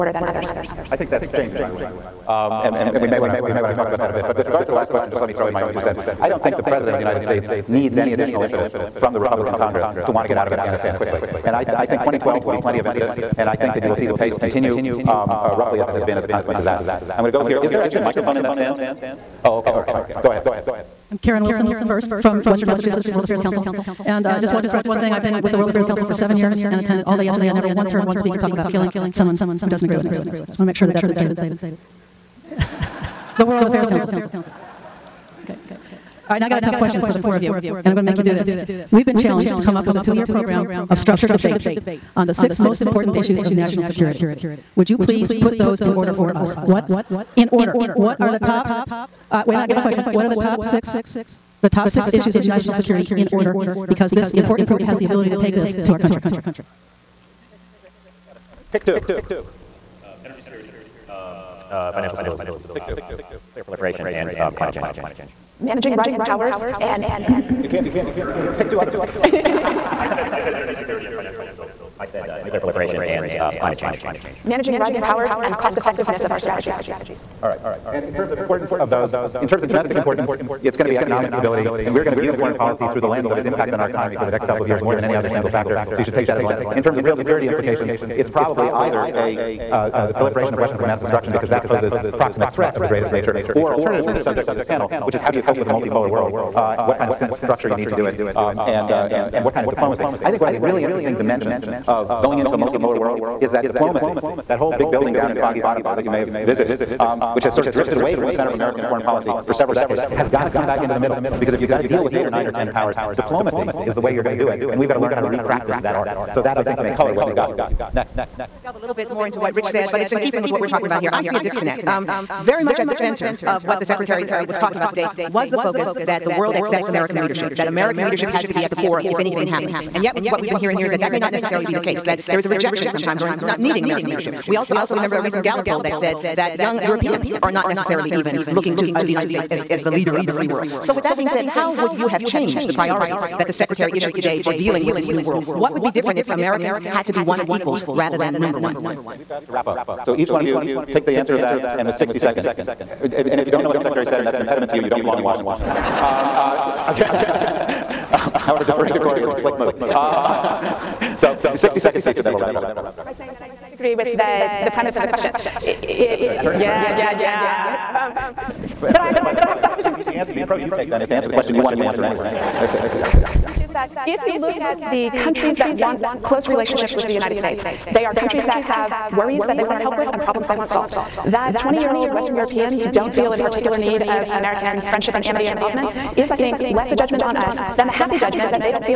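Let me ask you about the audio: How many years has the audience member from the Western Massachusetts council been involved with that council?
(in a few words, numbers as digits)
7.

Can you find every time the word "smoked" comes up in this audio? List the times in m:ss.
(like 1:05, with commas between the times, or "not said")
not said.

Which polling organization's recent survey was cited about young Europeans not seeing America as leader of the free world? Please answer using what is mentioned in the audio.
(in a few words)
Gallup.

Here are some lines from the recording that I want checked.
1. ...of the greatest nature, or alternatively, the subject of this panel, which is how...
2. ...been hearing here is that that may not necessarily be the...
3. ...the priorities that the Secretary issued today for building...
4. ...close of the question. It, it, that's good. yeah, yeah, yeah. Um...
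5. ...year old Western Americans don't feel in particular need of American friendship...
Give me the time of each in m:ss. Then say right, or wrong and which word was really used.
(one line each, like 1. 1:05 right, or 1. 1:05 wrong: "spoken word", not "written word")
1. 1:32 right
2. 2:10 right
3. 2:22 wrong: "dealing", not "building"
4. 2:44 wrong: "premise", not "close"
5. 3:01 wrong: "Europeans", not "Americans".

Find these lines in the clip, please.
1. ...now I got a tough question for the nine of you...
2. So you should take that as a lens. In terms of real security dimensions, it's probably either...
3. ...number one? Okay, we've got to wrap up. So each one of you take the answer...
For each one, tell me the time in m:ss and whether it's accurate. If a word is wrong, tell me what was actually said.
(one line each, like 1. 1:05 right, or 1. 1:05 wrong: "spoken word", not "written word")
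1. 0:36 wrong: "four", not "nine"
2. 1:25 wrong: "implications", not "dimensions"
3. 2:28 right.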